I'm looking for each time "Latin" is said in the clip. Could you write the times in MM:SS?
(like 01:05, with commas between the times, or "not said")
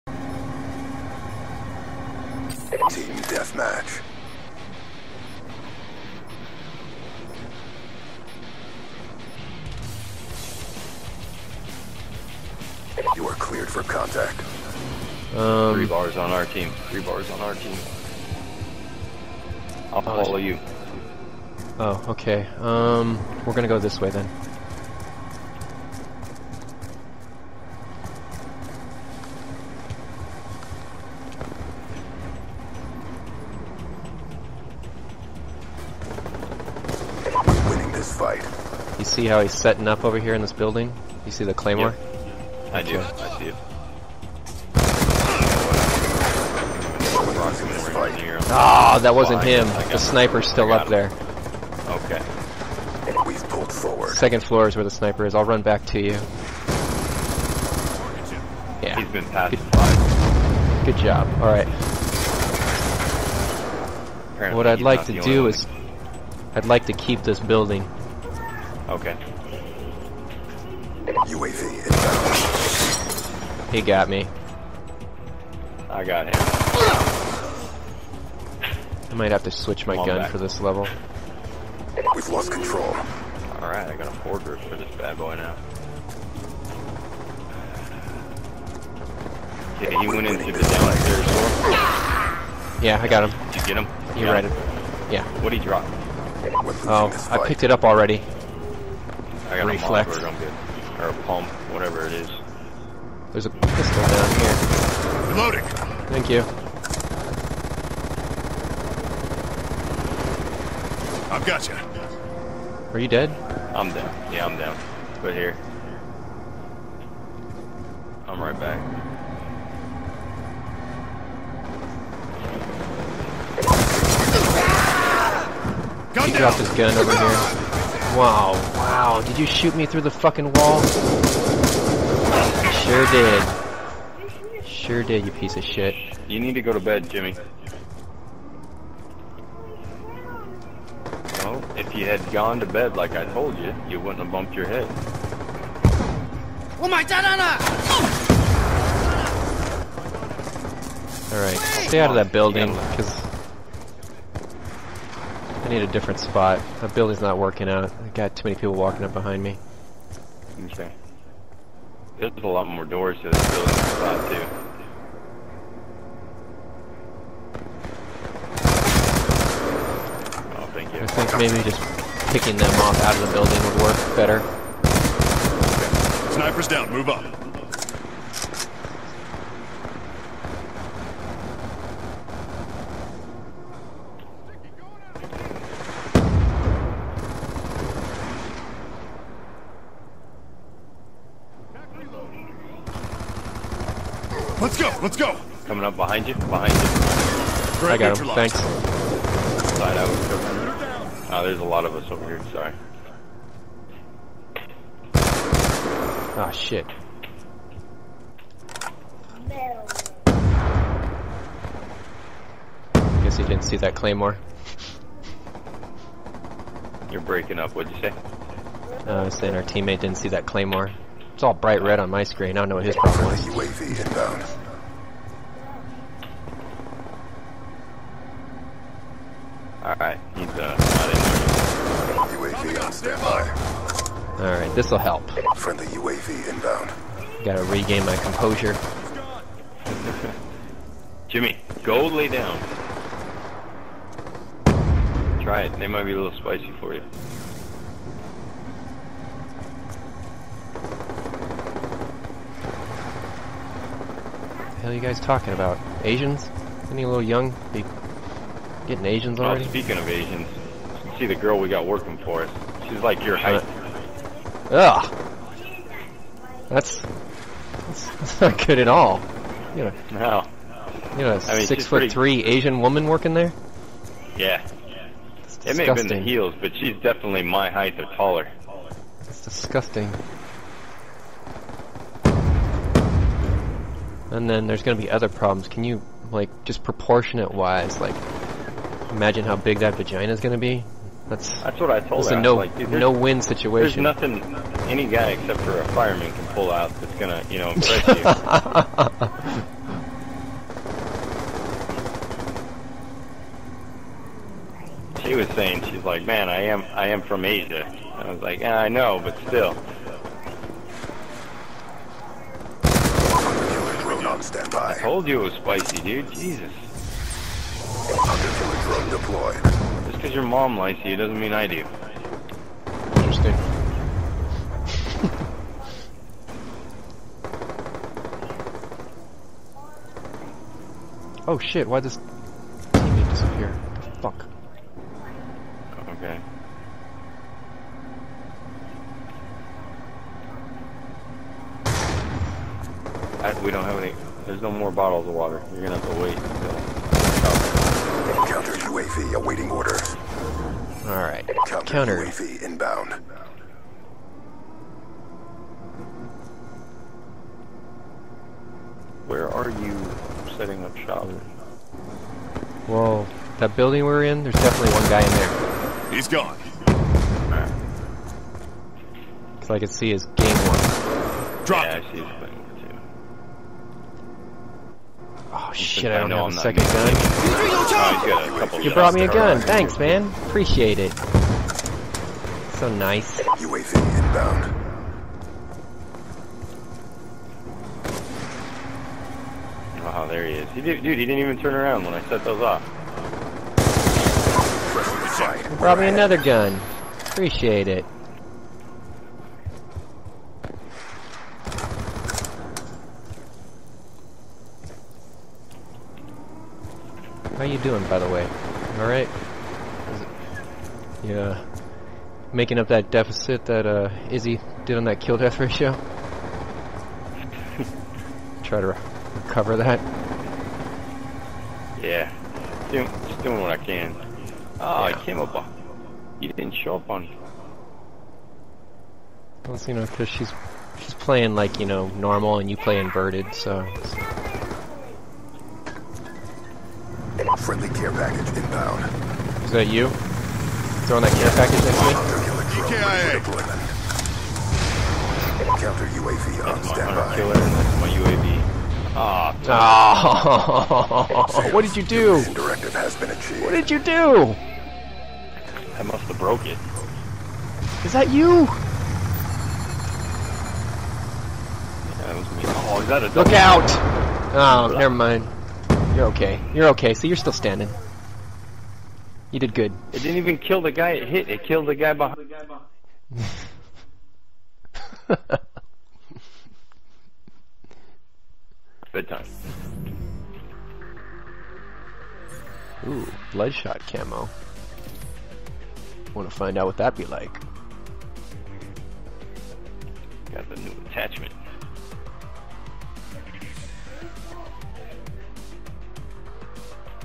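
not said.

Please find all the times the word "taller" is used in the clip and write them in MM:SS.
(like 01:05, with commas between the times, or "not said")
04:38.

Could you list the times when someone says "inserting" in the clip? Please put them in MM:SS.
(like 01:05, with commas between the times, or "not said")
not said.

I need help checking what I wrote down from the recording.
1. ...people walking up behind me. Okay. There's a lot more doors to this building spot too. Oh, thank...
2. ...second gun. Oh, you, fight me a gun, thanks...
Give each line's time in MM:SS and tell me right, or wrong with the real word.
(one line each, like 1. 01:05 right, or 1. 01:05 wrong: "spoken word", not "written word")
1. 02:38 right
2. 06:16 wrong: "brought", not "fight".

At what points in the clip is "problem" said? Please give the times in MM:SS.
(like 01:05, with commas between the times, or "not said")
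03:42, 04:45.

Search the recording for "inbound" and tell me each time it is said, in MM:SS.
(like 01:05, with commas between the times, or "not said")
01:11, 03:44, 03:56, 05:52, 06:24, 07:18.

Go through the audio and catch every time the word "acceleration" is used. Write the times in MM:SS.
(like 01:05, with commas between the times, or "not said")
not said.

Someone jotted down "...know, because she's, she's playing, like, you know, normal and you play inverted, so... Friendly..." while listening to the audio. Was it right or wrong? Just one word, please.
right.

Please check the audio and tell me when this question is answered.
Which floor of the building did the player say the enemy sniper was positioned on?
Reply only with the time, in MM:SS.
00:54.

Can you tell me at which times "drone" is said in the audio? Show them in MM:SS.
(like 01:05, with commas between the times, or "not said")
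05:14, 05:18.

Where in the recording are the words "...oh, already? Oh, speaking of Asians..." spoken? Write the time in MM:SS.
04:19.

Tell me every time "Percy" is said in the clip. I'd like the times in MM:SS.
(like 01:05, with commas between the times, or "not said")
not said.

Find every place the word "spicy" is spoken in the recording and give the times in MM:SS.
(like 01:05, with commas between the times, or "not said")
04:06, 05:15.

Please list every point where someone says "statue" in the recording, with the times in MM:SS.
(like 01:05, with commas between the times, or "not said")
not said.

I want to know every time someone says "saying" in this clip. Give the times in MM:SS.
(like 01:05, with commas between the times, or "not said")
03:39, 05:05.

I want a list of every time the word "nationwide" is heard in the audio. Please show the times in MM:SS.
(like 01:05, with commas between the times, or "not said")
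not said.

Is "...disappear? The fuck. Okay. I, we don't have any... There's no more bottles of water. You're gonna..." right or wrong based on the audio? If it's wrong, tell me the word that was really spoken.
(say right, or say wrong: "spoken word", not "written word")
right.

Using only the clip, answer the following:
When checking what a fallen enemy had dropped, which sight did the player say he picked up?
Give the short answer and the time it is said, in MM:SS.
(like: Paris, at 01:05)
Reflex, at 01:39.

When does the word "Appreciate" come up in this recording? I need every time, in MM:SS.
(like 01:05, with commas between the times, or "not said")
06:20, 06:37.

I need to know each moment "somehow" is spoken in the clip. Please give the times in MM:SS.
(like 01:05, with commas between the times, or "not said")
not said.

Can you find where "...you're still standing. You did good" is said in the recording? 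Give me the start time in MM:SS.
07:47.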